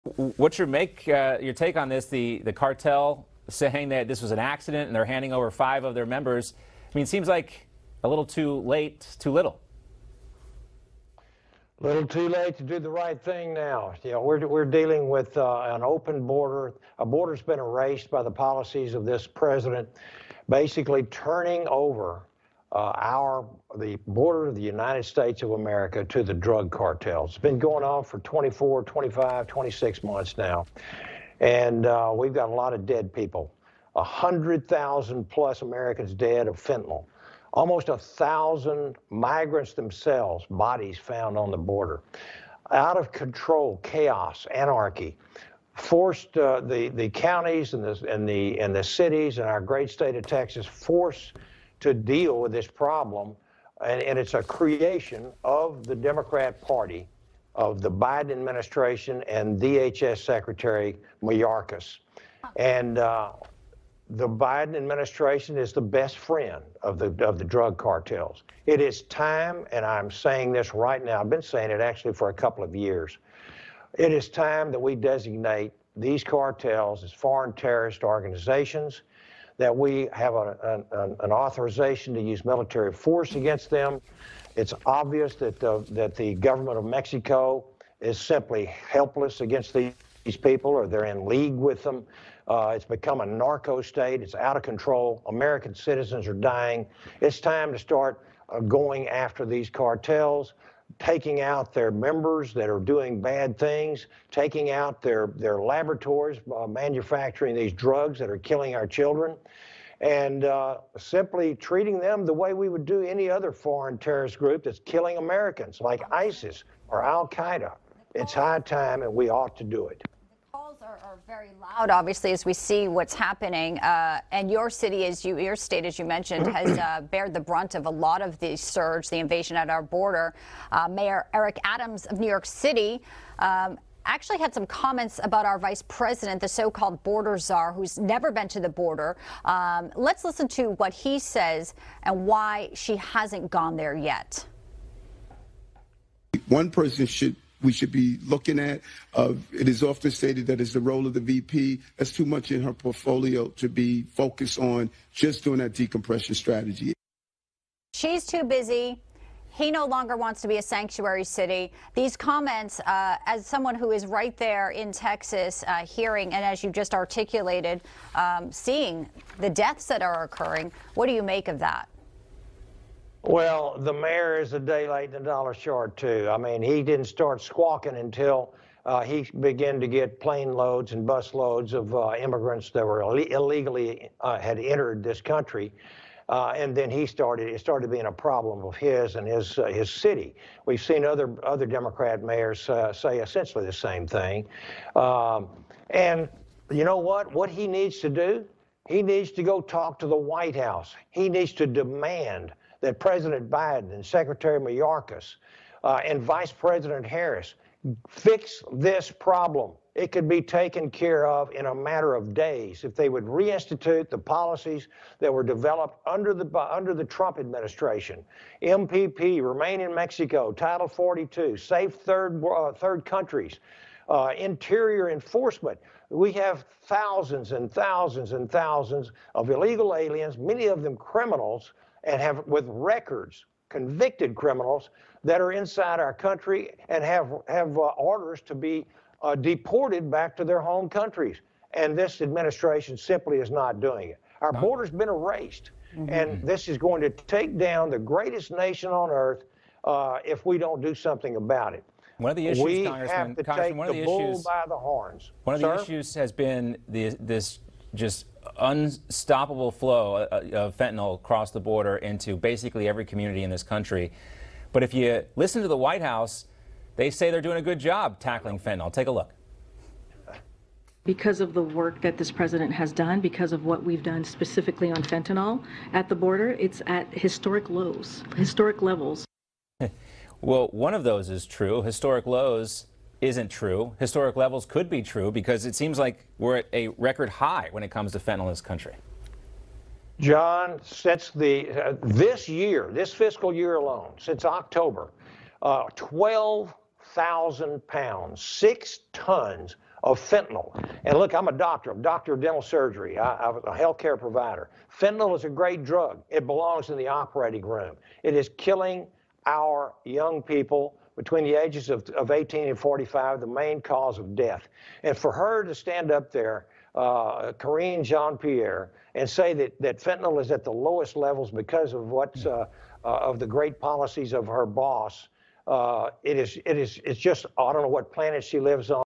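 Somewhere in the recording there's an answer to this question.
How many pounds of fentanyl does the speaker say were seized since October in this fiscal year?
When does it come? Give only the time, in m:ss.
4:55.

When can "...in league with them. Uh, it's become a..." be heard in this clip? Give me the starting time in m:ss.
1:31.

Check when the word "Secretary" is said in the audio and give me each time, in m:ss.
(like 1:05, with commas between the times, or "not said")
1:00, 3:24.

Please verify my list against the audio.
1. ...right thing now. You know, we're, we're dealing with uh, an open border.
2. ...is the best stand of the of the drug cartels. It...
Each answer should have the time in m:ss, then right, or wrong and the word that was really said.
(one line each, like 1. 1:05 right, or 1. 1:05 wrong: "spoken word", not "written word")
1. 0:12 right
2. 1:05 wrong: "friend", not "stand".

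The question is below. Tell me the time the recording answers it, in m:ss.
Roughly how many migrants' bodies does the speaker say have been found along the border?
0:37.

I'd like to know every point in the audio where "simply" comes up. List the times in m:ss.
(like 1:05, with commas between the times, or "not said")
1:28, 1:50, 4:02.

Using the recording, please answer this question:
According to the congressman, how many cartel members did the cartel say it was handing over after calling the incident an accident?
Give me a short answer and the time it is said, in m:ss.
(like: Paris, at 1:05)
5, at 0:05.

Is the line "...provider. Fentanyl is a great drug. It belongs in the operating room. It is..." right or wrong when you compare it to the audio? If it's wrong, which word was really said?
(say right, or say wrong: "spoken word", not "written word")
right.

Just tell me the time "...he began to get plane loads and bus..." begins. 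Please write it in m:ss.
2:59.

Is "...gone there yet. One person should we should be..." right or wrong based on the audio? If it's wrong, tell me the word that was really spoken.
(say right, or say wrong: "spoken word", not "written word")
right.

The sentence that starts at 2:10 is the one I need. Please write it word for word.
Uh, Mayor Eric Adams of New York City.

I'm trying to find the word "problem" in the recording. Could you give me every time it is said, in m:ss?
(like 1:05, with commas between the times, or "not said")
0:52, 3:08, 3:29.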